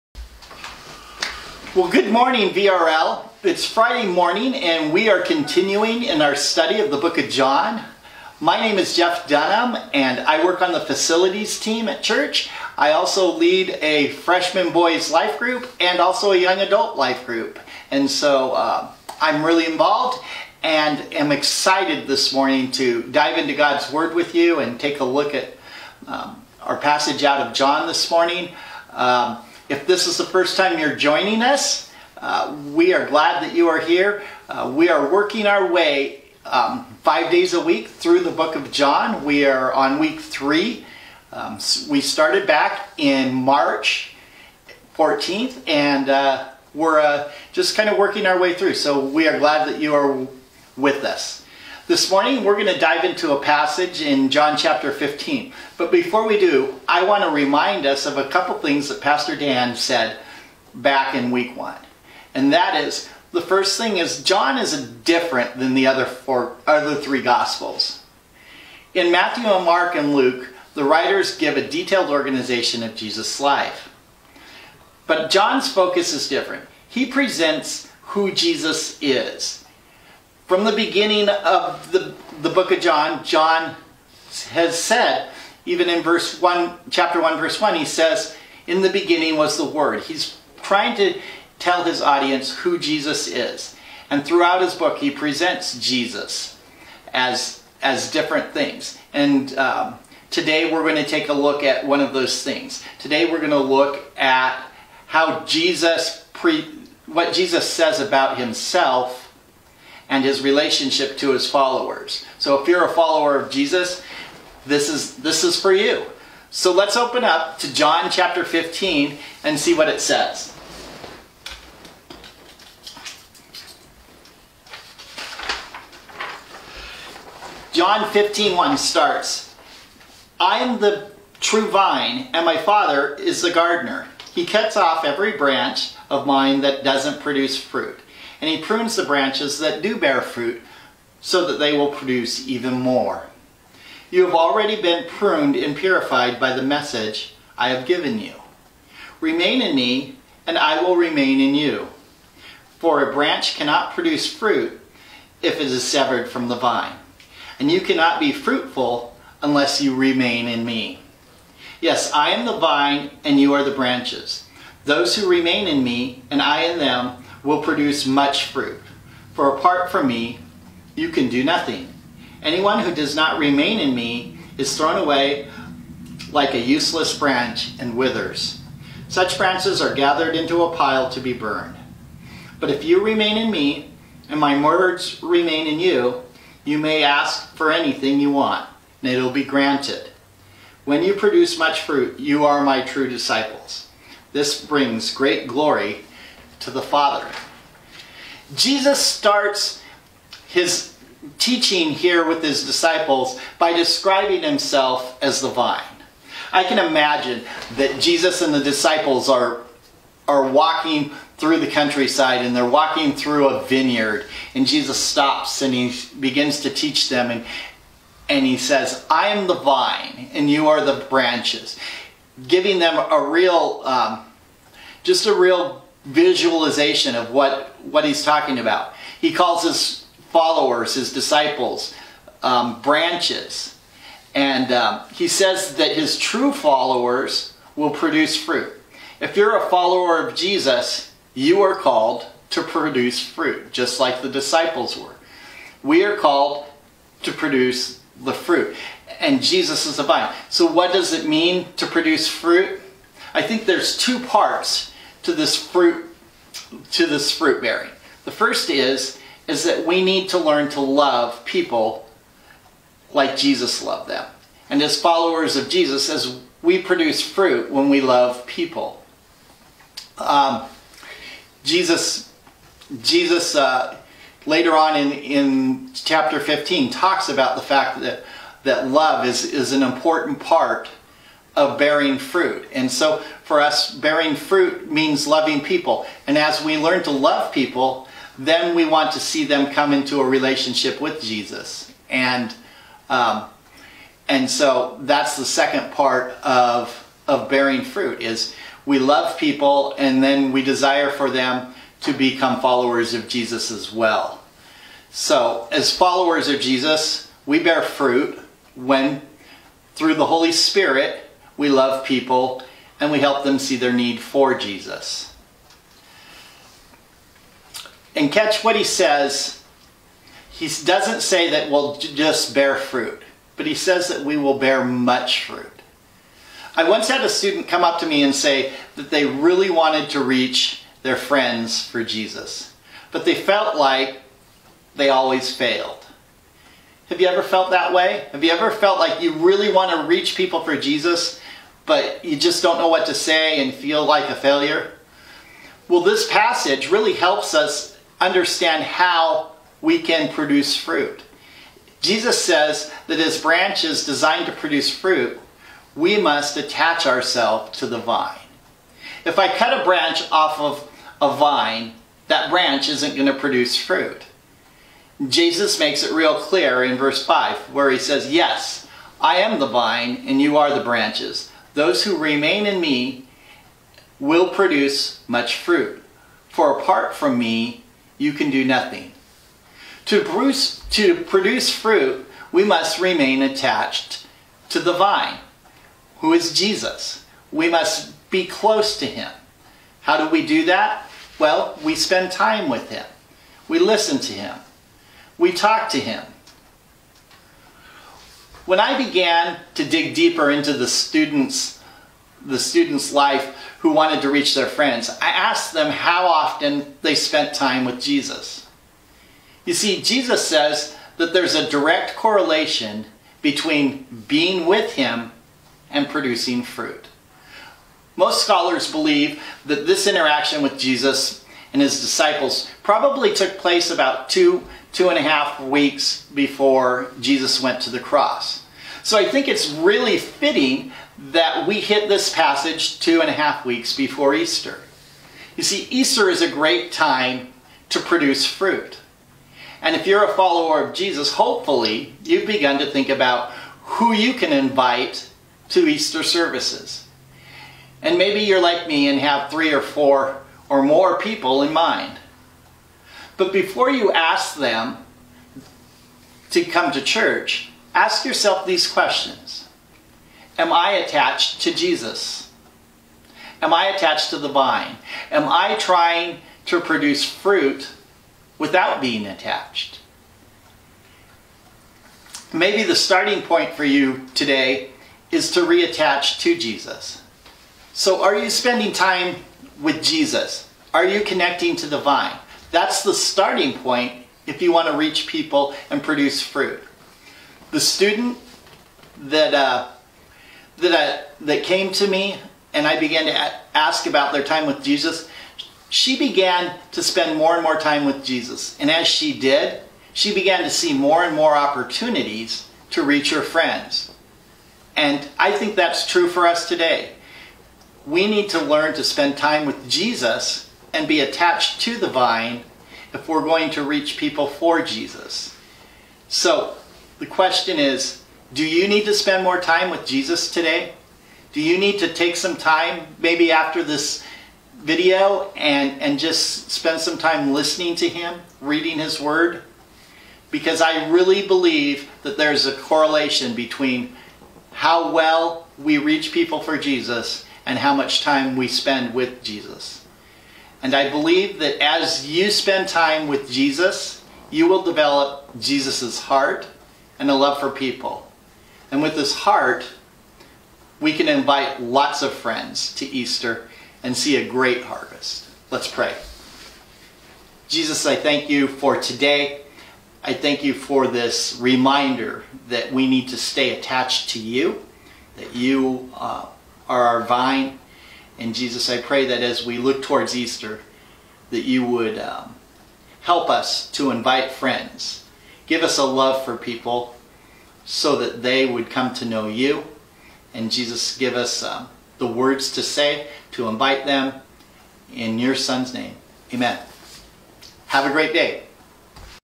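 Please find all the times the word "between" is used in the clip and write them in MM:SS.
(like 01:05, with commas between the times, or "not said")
06:53, 08:53.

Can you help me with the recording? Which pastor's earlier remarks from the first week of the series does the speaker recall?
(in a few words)
Pastor Dan.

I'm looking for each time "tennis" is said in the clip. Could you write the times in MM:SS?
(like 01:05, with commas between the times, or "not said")
not said.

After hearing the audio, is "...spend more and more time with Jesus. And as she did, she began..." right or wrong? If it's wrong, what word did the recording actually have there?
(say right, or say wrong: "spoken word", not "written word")
right.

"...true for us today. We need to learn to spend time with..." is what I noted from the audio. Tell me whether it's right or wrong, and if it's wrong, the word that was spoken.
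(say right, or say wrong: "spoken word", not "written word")
right.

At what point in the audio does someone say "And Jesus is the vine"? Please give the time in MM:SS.
04:09.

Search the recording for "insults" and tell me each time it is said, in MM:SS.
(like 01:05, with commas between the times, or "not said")
not said.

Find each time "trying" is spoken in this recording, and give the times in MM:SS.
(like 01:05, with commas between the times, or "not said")
01:30, 07:45.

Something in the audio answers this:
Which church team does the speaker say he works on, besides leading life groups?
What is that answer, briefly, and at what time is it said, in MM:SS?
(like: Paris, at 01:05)
facilities team, at 00:10.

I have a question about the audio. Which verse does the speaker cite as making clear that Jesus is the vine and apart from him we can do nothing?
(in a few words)
verse 5.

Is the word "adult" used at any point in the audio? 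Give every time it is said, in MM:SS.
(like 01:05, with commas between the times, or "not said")
00:16.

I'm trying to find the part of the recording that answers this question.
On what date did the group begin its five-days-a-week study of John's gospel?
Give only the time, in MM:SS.
00:43.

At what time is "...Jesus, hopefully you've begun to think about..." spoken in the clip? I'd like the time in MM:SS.
07:20.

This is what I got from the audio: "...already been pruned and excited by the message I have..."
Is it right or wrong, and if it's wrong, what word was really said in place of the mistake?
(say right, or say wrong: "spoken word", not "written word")
wrong: "purified", not "excited".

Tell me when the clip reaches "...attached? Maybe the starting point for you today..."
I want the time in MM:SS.
07:49.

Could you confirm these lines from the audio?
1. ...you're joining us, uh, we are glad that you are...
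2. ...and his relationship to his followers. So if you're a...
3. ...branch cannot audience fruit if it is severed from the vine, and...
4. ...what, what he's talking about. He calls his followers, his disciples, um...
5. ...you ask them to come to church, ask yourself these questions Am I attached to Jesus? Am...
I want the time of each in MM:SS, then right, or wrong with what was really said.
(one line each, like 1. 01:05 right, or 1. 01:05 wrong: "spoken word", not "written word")
1. 00:30 right
2. 01:50 right
3. 02:33 wrong: "produce", not "audience"
4. 03:47 right
5. 07:33 right.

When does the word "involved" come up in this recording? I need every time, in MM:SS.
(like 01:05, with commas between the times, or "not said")
00:19.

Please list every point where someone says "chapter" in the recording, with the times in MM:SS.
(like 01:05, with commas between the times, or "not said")
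00:54, 01:26, 01:58, 04:35.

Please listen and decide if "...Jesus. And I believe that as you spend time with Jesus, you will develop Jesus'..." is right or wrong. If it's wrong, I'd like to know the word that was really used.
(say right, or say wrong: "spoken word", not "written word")
right.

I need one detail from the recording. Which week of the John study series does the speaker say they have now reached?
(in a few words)
week three.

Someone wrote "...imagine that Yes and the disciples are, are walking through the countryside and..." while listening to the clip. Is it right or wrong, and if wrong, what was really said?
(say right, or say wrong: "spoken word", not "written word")
wrong: "Jesus", not "Yes".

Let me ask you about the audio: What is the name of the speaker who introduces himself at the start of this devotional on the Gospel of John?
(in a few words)
Jeff Dunham.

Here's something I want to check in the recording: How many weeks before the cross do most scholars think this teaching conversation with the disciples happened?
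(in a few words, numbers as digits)
2 and a half weeks.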